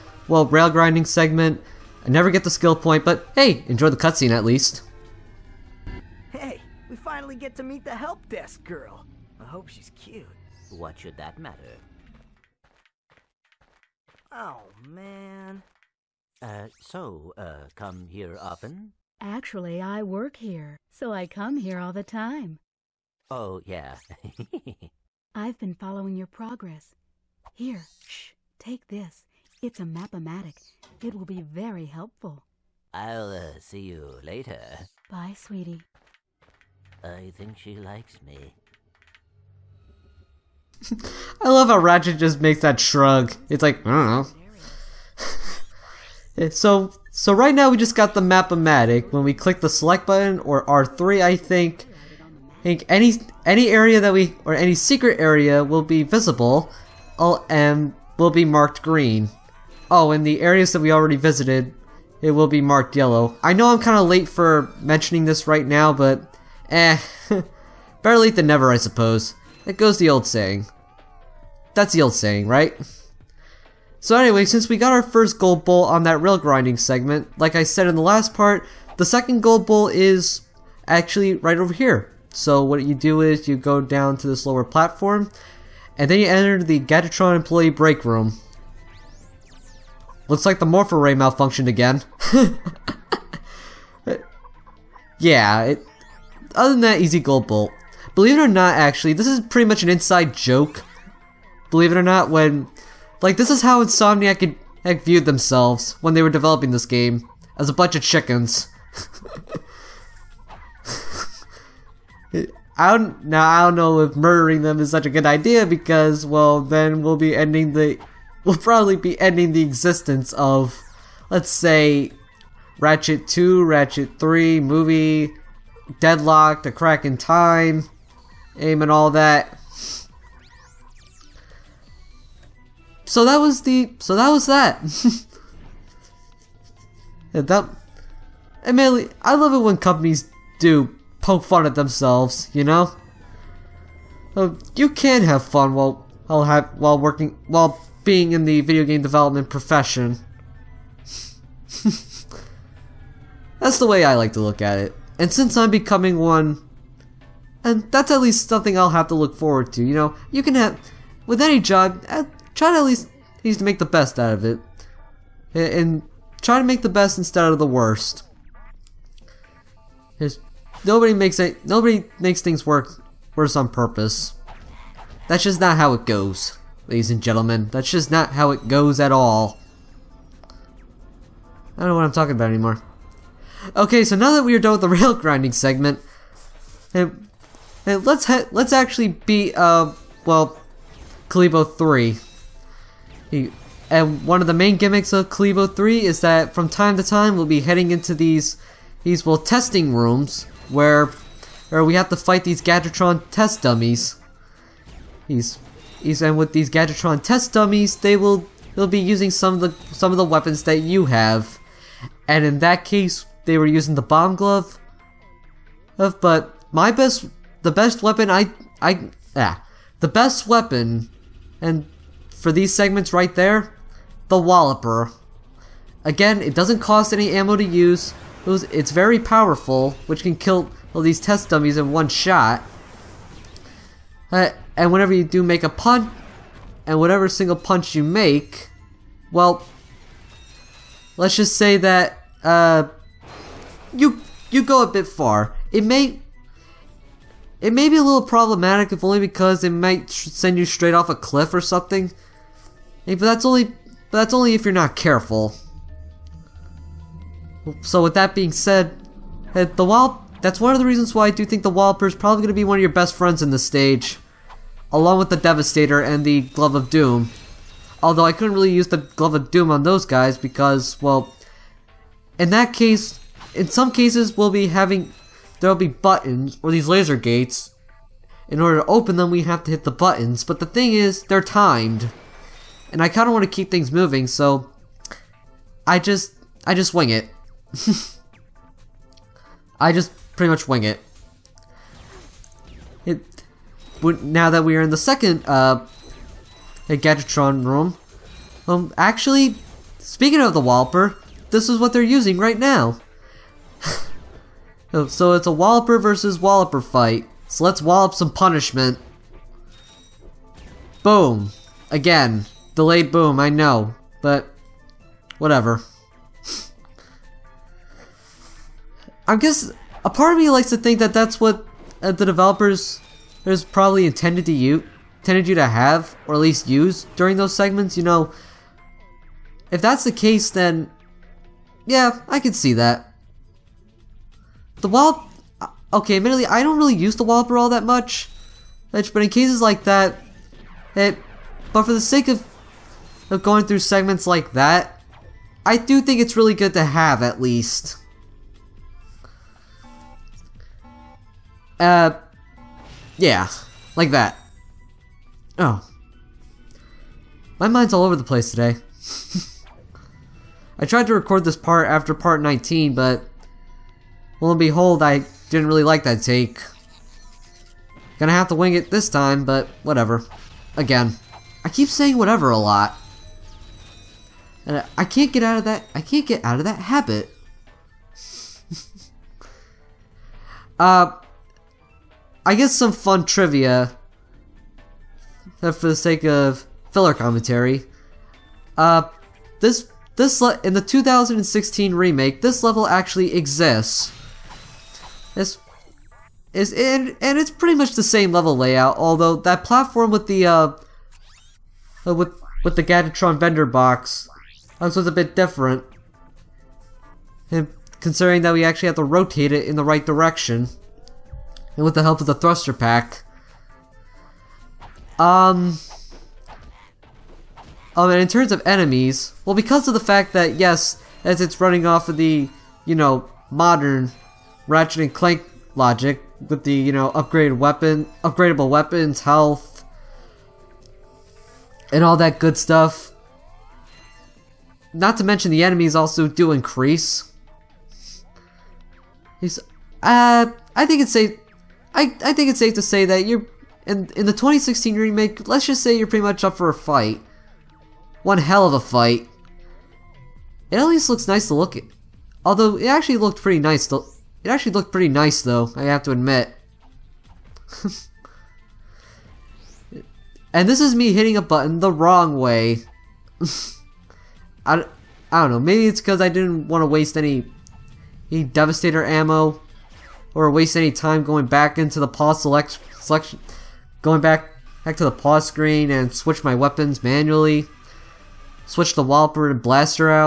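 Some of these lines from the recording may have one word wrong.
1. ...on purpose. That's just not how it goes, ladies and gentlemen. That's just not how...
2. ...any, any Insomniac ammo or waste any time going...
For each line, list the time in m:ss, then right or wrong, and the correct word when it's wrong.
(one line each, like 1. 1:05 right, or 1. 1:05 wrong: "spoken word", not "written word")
1. 2:53 right
2. 7:47 wrong: "Devastator", not "Insomniac".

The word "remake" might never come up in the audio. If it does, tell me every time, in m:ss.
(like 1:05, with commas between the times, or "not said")
6:31, 7:24.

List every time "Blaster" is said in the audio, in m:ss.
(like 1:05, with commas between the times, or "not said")
7:59.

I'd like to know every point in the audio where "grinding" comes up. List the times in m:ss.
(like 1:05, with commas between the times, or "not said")
0:00, 1:16, 3:05.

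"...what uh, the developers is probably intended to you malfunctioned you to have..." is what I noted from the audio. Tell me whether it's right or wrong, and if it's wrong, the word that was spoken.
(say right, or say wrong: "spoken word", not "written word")
wrong: "intended", not "malfunctioned".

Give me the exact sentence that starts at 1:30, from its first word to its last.
Looks like the Morph-o-Ray malfunctioned again.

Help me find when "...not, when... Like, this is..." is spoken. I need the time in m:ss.
1:42.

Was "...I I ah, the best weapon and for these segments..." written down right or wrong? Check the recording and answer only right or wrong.
right.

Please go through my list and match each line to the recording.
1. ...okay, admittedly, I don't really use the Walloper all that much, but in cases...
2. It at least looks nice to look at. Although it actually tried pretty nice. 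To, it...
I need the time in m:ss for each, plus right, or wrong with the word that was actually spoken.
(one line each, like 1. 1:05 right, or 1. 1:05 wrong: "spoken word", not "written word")
1. 5:35 right
2. 7:30 wrong: "looked", not "tried".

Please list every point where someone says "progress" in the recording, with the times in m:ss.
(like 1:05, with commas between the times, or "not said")
0:26.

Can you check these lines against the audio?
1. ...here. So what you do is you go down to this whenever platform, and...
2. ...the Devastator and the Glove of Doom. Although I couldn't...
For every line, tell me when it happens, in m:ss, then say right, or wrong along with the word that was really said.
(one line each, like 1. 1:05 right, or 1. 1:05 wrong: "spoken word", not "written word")
1. 1:21 wrong: "lower", not "whenever"
2. 4:25 right.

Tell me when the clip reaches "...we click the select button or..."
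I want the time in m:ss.
0:49.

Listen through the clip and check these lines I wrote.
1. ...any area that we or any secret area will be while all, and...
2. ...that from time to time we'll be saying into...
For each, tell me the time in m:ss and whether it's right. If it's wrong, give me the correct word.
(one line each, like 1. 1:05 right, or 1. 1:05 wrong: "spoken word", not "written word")
1. 0:53 wrong: "visible", not "while"
2. 3:16 wrong: "heading", not "saying".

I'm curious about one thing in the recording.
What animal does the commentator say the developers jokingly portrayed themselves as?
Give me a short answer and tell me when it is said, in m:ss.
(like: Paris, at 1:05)
Chickens, at 1:48.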